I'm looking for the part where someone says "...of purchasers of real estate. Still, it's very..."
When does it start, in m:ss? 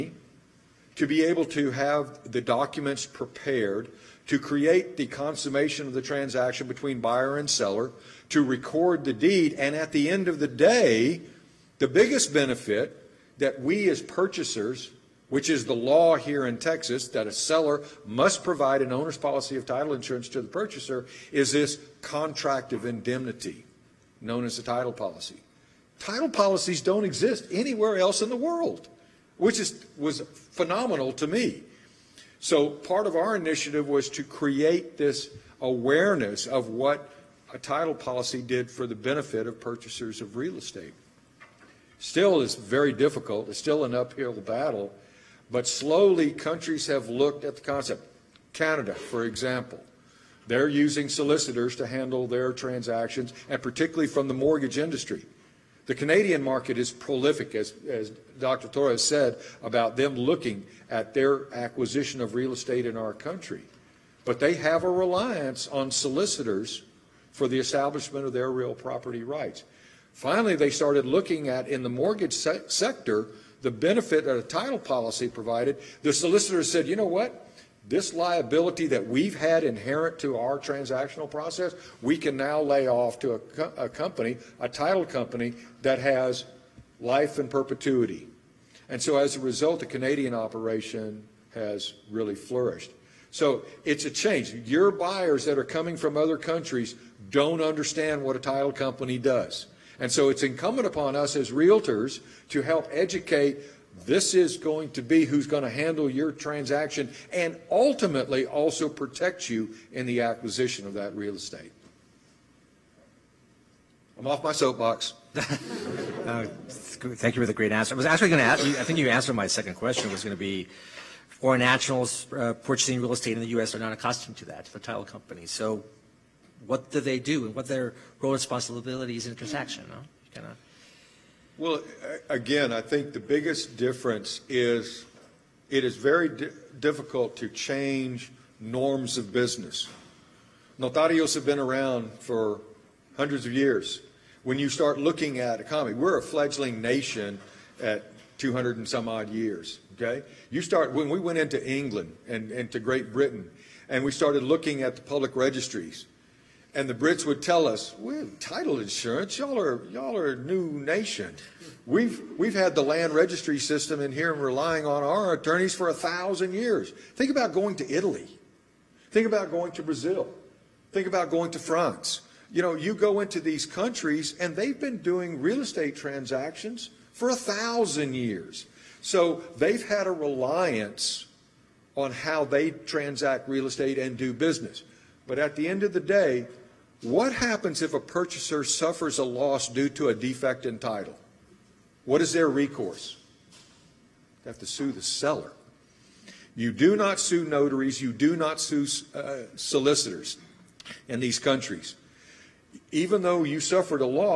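0:39.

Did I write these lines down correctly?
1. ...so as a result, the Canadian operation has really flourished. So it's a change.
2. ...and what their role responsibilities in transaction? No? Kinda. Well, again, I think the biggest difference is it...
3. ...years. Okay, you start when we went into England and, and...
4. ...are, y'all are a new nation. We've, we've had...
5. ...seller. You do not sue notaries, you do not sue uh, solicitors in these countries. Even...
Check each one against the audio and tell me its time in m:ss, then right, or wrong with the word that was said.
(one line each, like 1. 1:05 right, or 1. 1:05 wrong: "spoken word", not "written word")
1. 1:28 right
2. 2:07 right
3. 2:29 right
4. 2:39 right
5. 3:15 right.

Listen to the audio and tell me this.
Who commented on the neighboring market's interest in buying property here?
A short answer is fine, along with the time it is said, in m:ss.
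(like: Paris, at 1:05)
Dr. Torres, at 0:58.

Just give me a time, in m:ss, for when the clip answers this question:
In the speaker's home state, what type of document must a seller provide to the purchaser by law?
0:18.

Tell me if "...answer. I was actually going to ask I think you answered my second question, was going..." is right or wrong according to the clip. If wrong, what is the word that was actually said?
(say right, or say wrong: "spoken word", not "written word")
right.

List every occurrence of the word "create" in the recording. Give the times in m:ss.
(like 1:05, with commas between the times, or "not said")
0:04, 0:34.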